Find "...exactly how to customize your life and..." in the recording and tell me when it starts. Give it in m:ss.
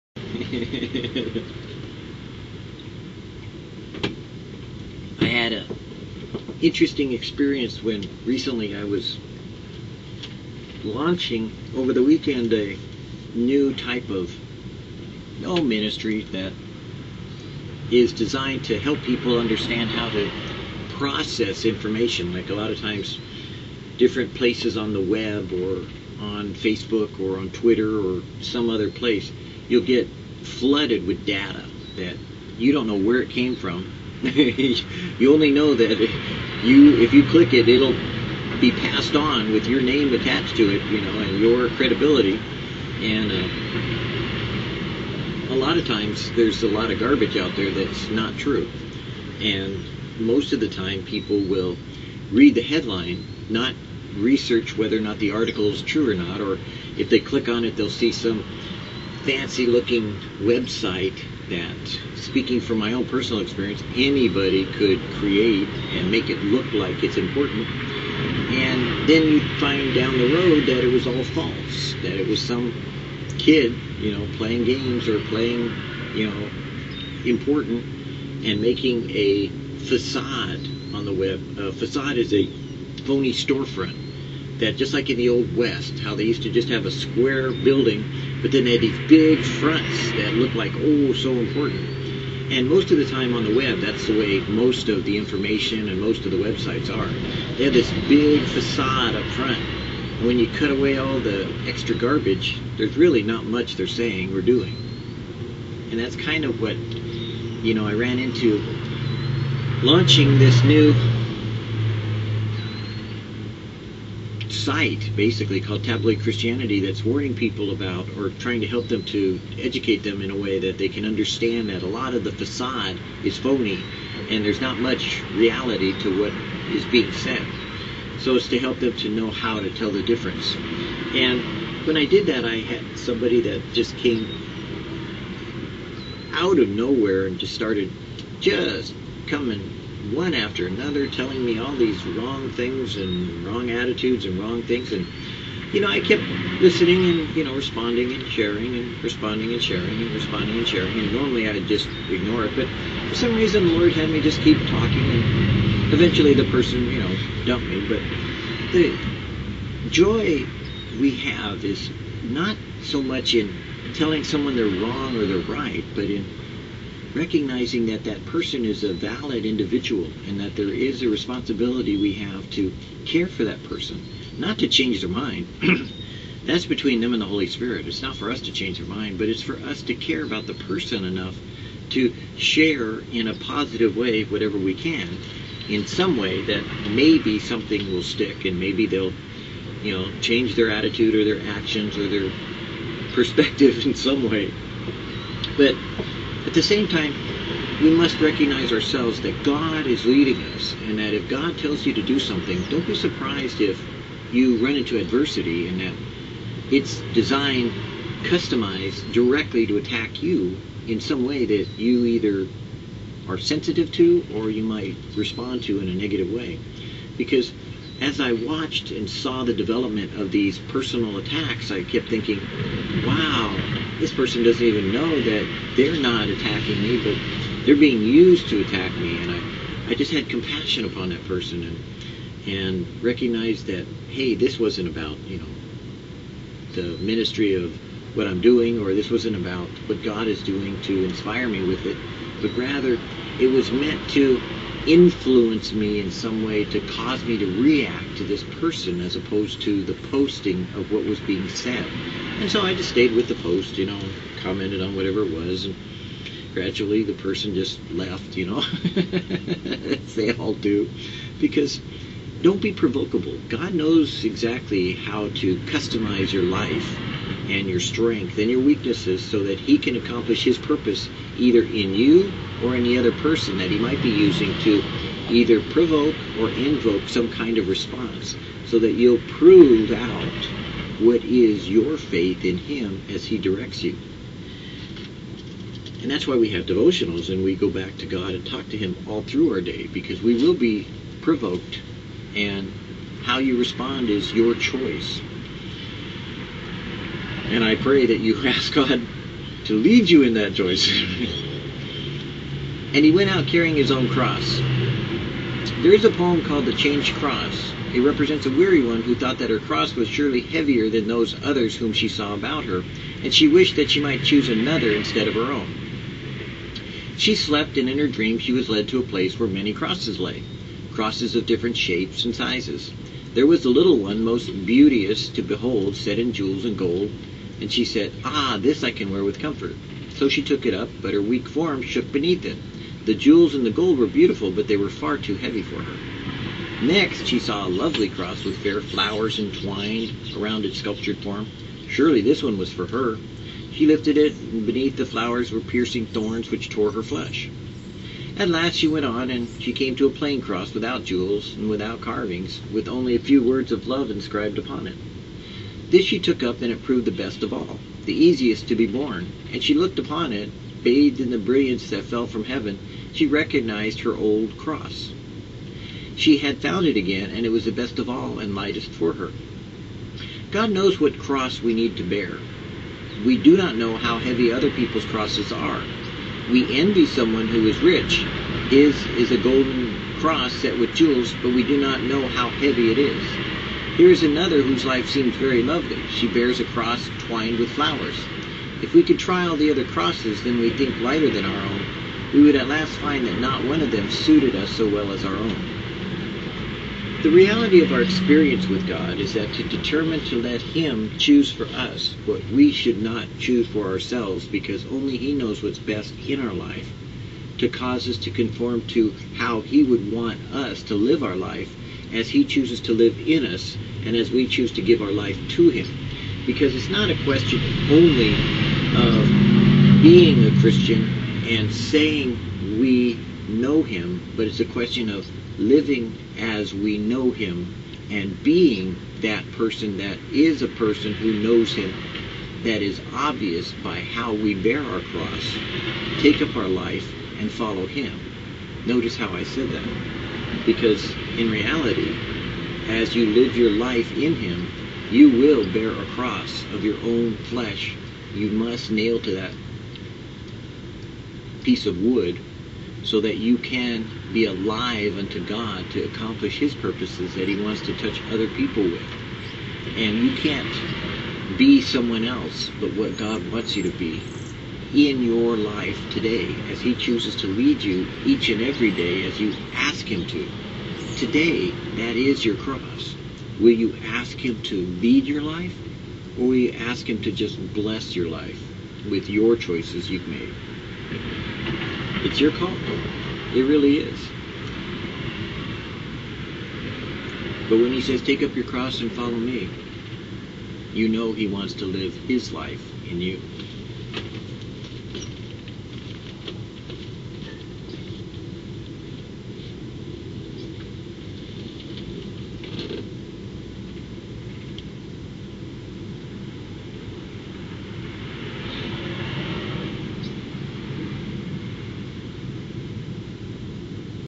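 4:24.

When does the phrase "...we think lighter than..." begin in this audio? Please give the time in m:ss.
6:30.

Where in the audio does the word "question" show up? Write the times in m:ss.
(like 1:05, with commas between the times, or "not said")
6:57, 7:04.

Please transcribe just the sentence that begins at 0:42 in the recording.
And uh, a lot of times, there's a lot of garbage out there that's not true.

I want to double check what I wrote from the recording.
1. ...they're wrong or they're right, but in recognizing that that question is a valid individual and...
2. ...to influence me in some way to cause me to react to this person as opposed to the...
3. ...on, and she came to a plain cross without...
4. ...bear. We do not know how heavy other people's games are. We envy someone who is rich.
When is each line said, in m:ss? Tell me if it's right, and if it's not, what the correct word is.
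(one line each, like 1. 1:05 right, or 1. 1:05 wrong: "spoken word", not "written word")
1. 2:44 wrong: "person", not "question"
2. 4:04 right
3. 5:49 right
4. 6:12 wrong: "crosses", not "games".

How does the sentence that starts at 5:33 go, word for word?
The jewels and the gold were beautiful, but they were far too heavy for her.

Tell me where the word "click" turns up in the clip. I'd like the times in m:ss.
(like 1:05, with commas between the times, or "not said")
0:37, 0:57.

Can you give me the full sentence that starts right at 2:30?
And normally I'd just ignore it.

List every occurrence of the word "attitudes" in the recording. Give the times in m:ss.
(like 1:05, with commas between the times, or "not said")
2:23, 3:10.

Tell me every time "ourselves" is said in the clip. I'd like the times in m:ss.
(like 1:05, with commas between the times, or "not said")
3:18, 6:43.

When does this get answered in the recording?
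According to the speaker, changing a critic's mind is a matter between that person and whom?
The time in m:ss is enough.
2:57.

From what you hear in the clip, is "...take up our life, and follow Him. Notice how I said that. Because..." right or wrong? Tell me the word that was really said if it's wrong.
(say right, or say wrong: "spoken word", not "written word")
right.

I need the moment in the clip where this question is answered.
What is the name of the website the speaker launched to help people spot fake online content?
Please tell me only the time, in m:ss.
1:55.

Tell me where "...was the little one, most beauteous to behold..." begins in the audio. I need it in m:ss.
5:23.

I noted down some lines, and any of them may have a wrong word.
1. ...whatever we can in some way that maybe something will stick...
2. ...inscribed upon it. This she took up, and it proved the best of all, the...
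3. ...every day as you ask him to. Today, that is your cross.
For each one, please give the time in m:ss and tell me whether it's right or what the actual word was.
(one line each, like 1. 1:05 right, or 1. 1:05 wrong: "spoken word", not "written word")
1. 3:04 right
2. 5:54 right
3. 7:48 right.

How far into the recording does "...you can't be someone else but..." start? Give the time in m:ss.
7:40.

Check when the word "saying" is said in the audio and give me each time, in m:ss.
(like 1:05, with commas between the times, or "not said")
1:43, 7:01.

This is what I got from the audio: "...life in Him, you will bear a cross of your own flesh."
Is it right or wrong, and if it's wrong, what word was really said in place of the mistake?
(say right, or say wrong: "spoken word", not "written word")
right.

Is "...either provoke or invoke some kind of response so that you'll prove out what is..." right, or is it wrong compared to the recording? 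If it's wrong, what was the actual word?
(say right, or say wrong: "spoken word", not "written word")
right.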